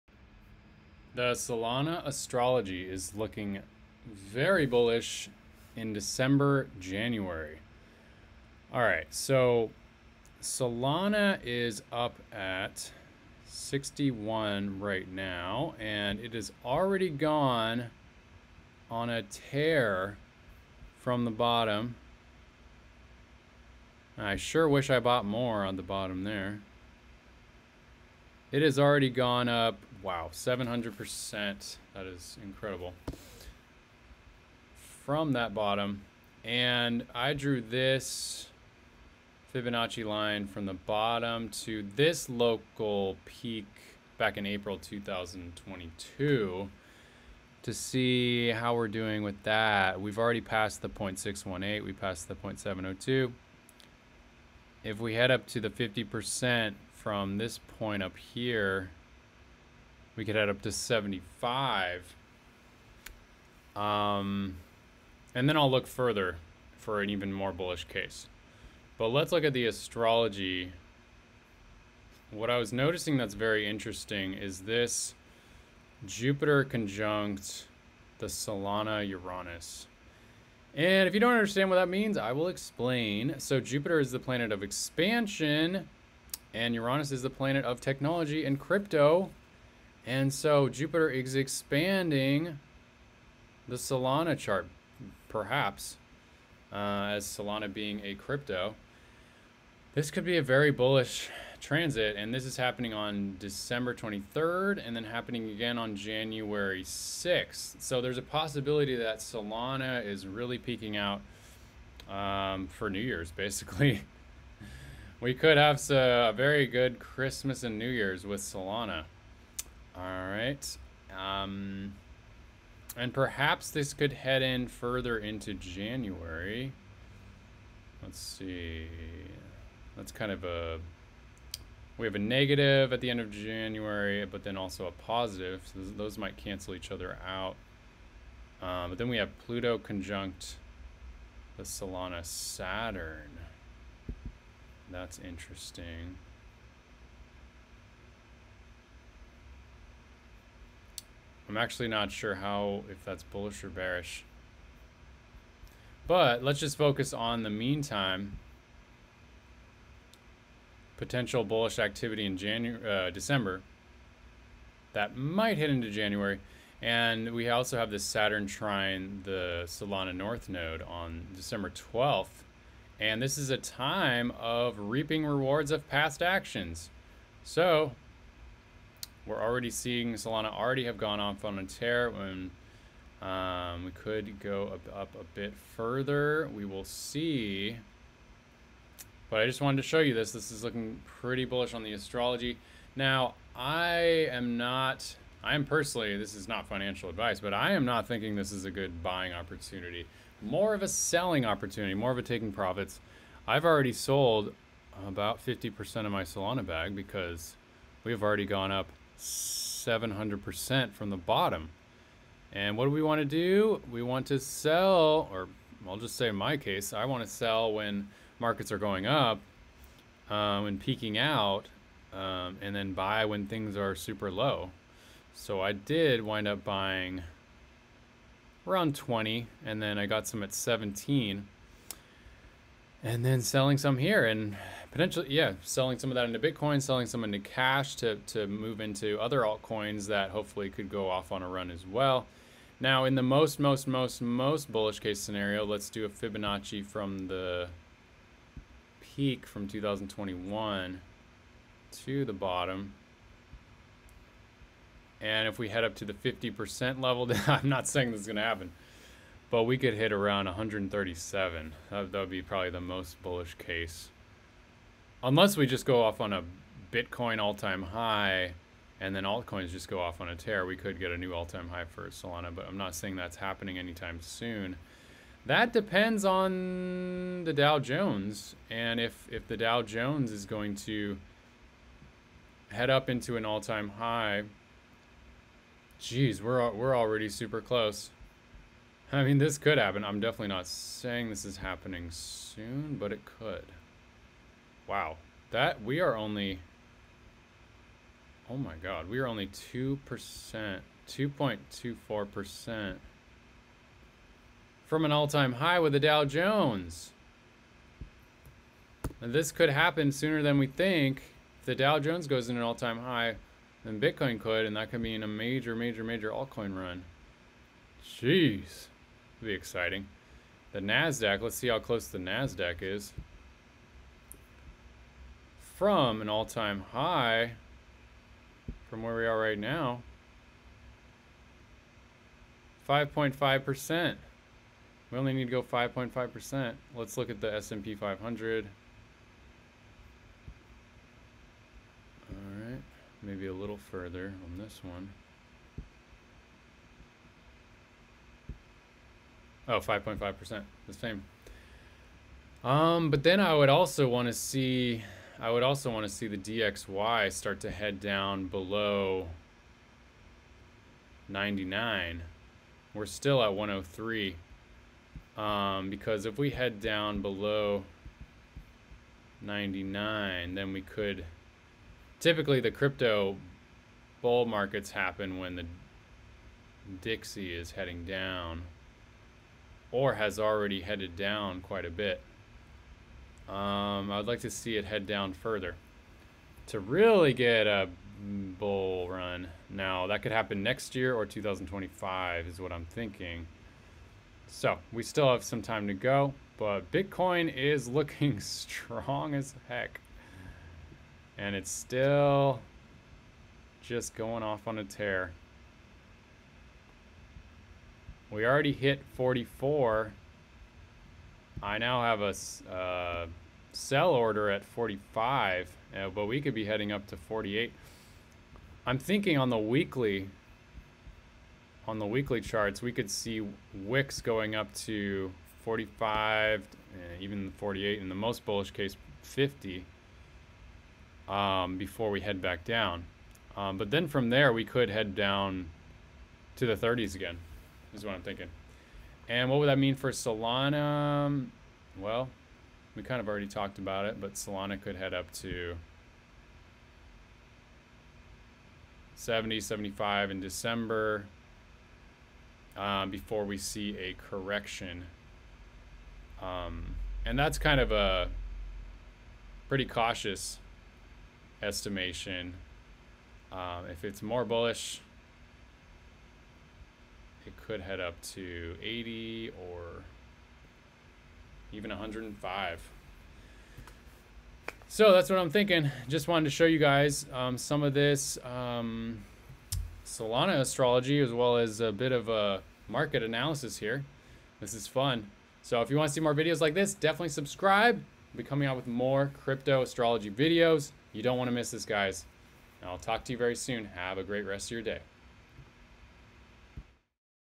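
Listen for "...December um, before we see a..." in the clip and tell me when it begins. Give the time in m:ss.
7:30.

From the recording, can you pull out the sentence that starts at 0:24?
I sure wish I bought more on the bottom there.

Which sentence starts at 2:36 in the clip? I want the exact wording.
But let's just focus on the meantime.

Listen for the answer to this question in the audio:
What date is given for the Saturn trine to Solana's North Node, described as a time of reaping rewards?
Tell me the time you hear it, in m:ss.
2:51.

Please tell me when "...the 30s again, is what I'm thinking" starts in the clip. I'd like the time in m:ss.
7:16.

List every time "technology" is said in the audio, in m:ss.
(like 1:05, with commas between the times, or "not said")
1:27.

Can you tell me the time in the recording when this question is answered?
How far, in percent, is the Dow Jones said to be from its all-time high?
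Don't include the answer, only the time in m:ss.
5:01.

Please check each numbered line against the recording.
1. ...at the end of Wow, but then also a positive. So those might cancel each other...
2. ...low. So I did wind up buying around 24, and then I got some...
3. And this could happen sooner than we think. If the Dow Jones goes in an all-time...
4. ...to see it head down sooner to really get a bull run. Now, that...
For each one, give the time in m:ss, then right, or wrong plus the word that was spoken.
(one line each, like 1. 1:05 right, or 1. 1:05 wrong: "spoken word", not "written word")
1. 2:12 wrong: "January", not "Wow"
2. 3:44 wrong: "20", not "24"
3. 5:09 right
4. 6:24 wrong: "further", not "sooner".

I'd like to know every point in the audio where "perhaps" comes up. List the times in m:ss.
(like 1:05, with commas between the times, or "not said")
1:35, 2:03.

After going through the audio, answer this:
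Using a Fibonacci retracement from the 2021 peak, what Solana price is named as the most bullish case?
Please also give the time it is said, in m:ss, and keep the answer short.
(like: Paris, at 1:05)
137, at 4:20.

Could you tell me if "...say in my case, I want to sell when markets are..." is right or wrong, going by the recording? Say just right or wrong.
right.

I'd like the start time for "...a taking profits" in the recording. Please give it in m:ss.
3:22.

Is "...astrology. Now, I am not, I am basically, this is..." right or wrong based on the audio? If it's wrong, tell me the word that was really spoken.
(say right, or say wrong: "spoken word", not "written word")
wrong: "personally", not "basically".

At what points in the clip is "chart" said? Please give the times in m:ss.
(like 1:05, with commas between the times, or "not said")
1:34, 7:02.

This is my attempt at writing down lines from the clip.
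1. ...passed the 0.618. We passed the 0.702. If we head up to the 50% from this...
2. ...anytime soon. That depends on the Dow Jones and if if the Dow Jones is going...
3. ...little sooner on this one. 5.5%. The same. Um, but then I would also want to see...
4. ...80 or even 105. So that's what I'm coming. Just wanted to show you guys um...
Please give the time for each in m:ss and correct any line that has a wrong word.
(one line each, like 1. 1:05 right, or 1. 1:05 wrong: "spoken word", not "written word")
1. 0:50 right
2. 4:33 right
3. 5:43 wrong: "further", not "sooner"
4. 7:48 wrong: "thinking", not "coming".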